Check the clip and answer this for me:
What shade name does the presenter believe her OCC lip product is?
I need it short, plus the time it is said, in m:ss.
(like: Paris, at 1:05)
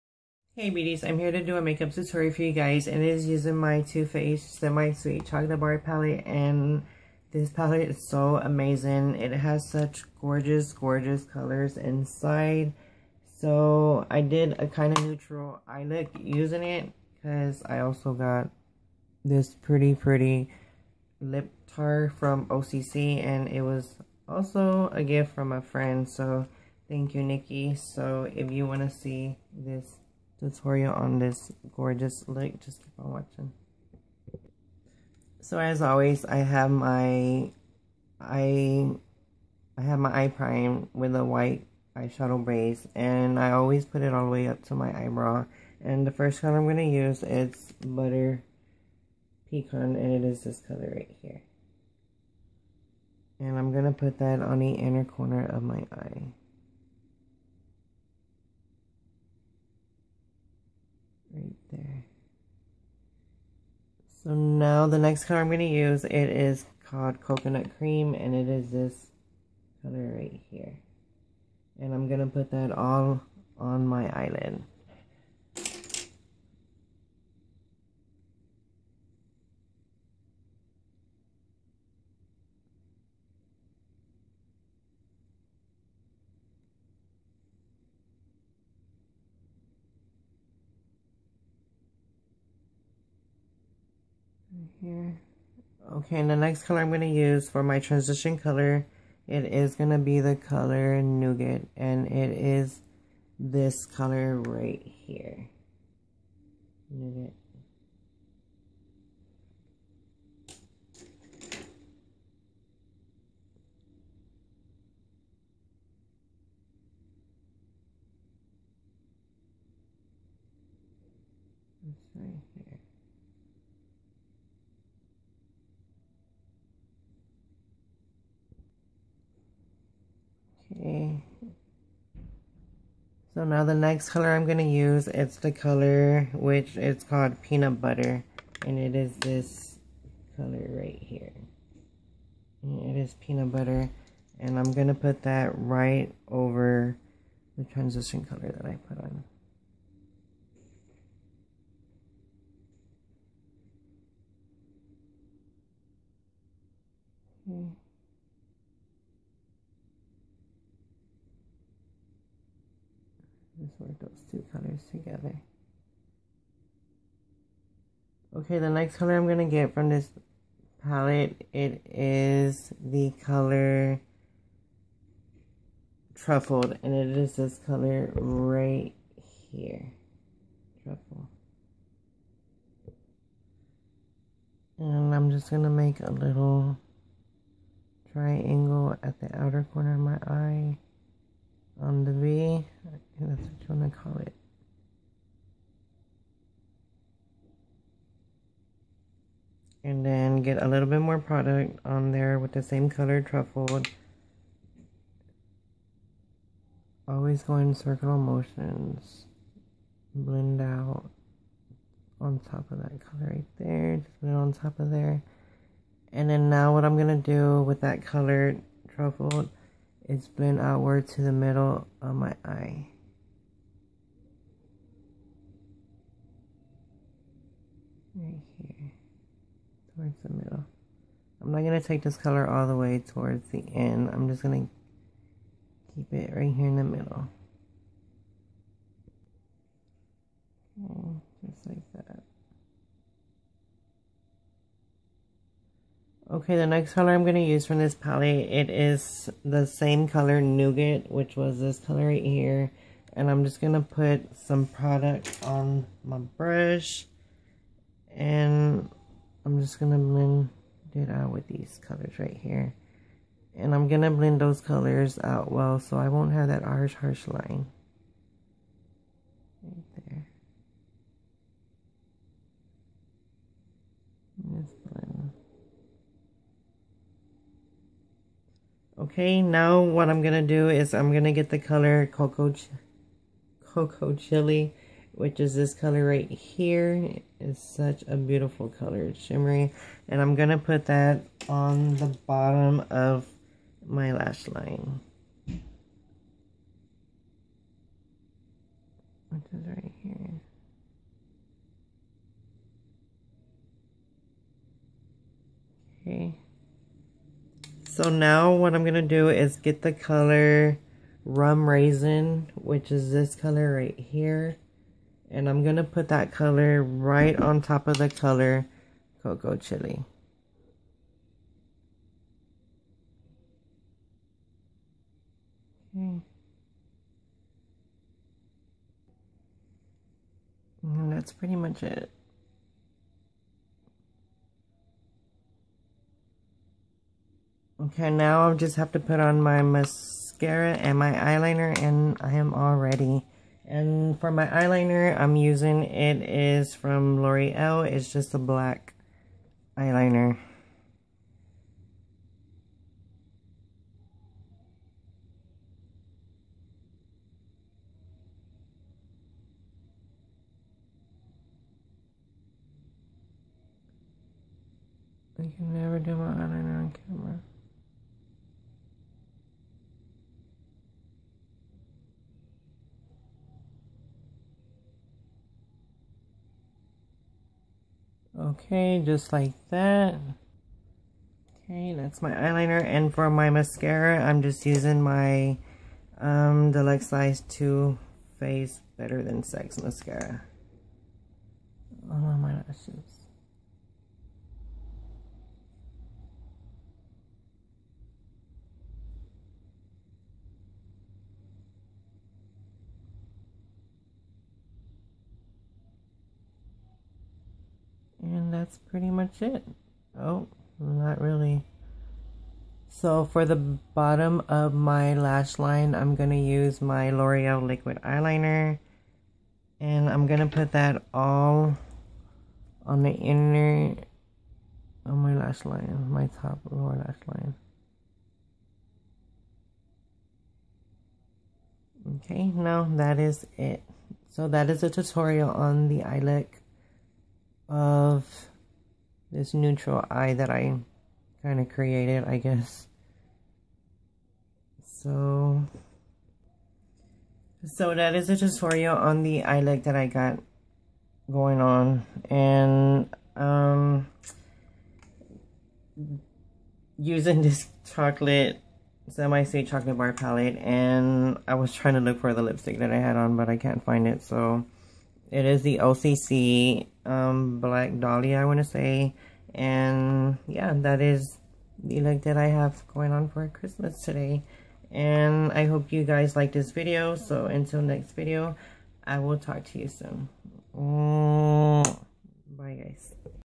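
Black Dahlia, at 7:47.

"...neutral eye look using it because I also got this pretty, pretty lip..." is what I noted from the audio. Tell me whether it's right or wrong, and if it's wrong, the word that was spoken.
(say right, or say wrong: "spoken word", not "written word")
right.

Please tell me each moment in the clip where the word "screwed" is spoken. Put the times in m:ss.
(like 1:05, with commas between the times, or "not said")
not said.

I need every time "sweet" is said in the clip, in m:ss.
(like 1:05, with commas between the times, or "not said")
0:04, 7:39.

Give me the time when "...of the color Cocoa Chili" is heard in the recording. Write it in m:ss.
5:17.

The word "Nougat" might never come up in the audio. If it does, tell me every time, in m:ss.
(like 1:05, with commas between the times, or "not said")
1:41, 1:46, 4:10.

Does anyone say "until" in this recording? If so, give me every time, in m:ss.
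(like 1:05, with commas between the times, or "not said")
7:57.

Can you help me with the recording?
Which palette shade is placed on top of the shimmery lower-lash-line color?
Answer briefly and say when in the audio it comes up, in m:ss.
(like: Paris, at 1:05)
Rum Raisin, at 5:11.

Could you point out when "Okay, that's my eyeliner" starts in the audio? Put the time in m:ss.
6:21.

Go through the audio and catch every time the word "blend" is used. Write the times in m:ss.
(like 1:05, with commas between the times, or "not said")
3:30, 3:40, 4:19, 4:24, 4:34.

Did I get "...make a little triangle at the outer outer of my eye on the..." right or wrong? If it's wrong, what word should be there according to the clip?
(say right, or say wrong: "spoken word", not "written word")
wrong: "corner", not "outer".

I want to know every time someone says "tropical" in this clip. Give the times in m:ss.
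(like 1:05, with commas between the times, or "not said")
not said.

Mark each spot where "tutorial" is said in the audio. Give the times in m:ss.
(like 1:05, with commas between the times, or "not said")
0:01, 0:30, 7:14, 7:28.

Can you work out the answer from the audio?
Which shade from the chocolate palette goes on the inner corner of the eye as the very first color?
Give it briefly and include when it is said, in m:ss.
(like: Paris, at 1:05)
Butter Pecan, at 0:47.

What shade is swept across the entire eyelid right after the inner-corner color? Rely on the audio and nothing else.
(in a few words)
Coconut Cream.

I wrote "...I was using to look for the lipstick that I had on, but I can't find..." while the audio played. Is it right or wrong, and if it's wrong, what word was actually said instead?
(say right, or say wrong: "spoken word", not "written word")
wrong: "trying", not "using".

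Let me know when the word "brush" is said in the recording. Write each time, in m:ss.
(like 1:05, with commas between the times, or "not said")
4:16.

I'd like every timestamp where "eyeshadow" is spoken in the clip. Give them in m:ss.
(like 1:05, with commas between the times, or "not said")
0:41.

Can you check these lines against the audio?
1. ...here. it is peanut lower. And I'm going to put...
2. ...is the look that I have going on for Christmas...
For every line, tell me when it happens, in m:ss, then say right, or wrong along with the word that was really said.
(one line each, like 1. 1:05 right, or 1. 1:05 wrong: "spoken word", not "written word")
1. 2:21 wrong: "butter", not "lower"
2. 7:51 right.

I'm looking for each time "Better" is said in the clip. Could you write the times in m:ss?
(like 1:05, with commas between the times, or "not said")
6:28.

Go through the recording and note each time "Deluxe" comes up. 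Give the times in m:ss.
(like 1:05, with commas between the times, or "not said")
6:26.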